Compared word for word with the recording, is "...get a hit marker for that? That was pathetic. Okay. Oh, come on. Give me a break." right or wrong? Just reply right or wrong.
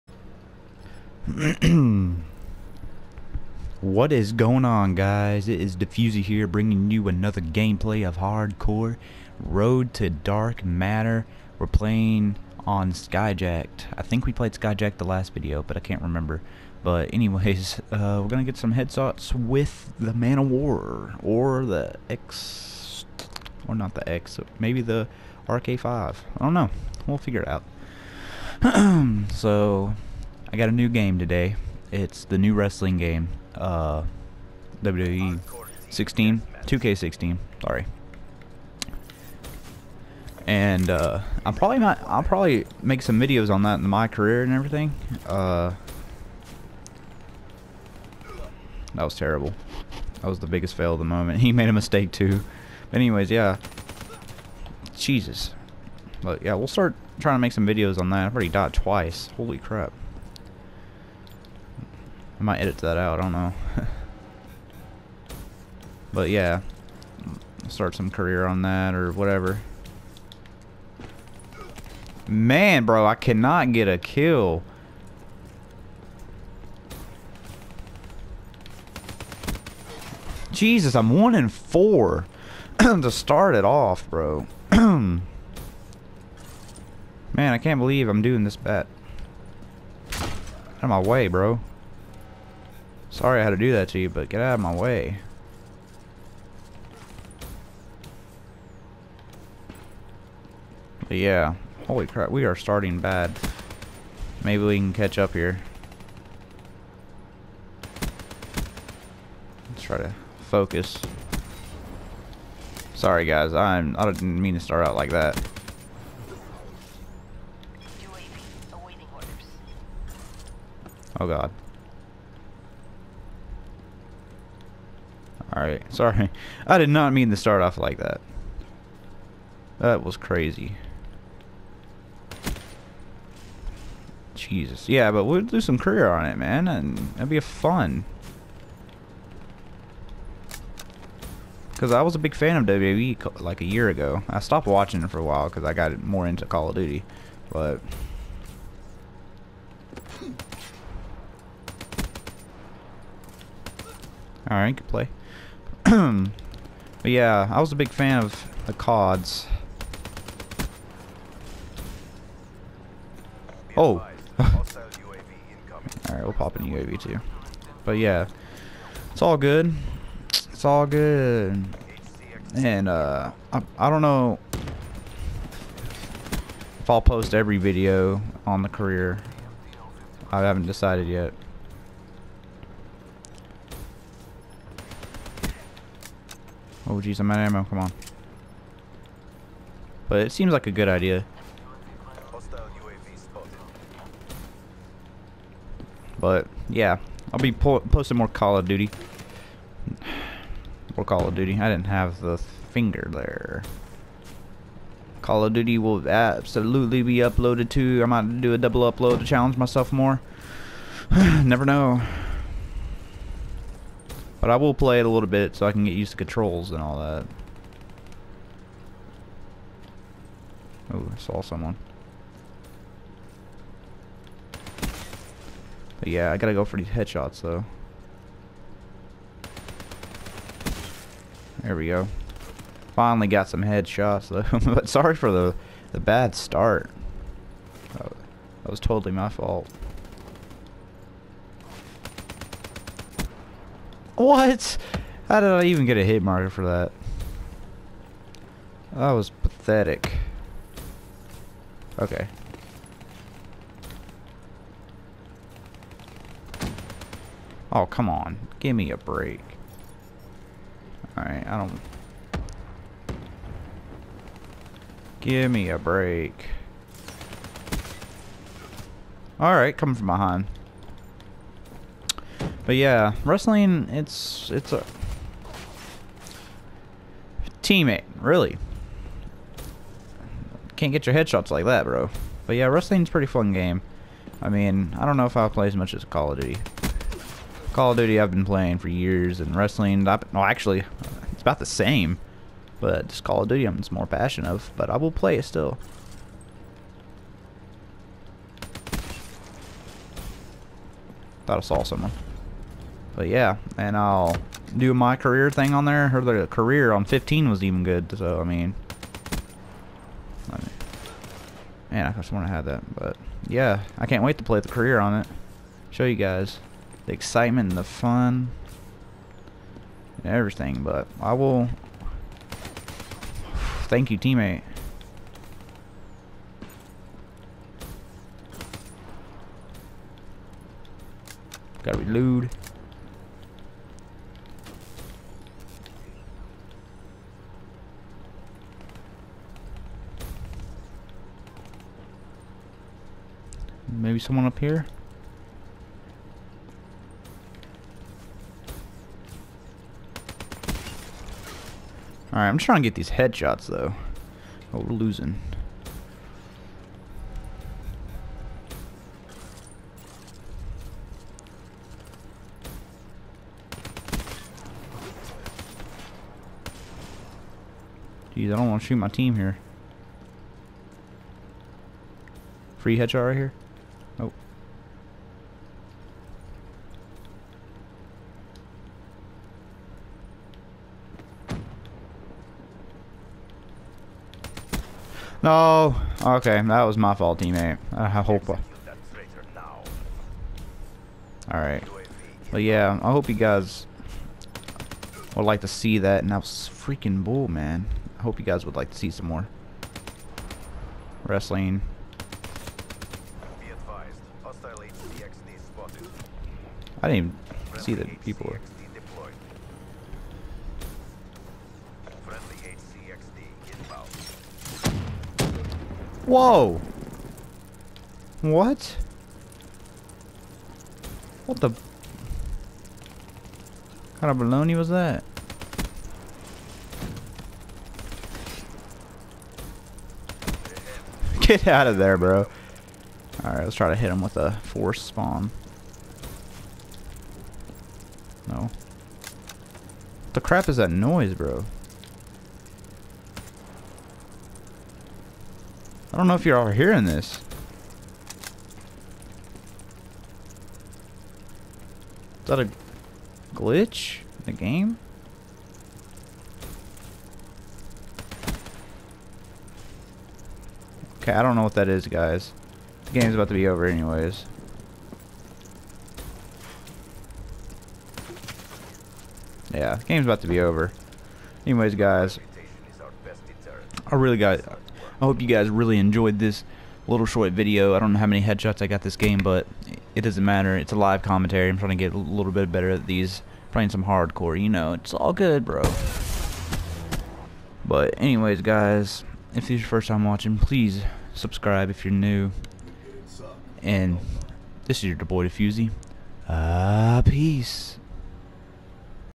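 right.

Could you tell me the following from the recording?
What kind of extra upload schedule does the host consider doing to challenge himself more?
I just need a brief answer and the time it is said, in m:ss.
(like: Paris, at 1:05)
Double upload, at 3:28.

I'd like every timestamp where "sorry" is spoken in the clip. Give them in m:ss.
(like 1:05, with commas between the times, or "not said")
0:37, 1:33, 1:52, 2:05, 3:54.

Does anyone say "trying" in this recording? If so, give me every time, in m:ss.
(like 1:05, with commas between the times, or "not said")
0:57, 5:52, 8:01.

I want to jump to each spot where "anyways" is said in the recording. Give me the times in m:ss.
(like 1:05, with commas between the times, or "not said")
0:17, 0:52, 7:43, 7:51, 8:08.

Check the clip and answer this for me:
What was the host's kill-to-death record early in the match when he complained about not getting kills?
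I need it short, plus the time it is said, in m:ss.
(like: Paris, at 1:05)
1 and 4, at 1:21.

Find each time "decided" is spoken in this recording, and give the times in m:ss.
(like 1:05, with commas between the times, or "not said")
3:00.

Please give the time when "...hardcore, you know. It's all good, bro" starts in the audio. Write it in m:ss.
8:04.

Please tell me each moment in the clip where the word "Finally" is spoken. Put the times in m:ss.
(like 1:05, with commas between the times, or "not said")
3:52.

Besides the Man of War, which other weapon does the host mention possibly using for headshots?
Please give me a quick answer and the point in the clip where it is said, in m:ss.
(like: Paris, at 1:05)
RK5, at 0:24.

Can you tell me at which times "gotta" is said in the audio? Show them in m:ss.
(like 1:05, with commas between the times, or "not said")
3:46, 5:31.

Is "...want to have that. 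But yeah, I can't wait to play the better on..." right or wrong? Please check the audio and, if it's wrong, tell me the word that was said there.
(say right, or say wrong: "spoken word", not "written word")
wrong: "career", not "better".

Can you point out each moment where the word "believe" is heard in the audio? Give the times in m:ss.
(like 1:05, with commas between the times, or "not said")
1:27.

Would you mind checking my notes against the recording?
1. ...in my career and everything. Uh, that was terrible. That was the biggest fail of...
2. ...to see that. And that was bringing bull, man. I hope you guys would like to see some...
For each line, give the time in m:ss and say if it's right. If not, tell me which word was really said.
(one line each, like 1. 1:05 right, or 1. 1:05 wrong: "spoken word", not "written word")
1. 0:43 right
2. 6:35 wrong: "freaking", not "bringing".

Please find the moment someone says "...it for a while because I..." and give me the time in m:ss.
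2:25.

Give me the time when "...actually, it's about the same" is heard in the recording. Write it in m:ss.
4:50.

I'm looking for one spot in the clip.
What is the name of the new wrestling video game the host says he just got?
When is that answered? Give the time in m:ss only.
0:36.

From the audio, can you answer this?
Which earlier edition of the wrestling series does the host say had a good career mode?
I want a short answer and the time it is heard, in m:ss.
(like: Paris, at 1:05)
15, at 5:06.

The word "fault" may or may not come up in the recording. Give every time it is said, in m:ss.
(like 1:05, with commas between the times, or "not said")
3:59, 6:27.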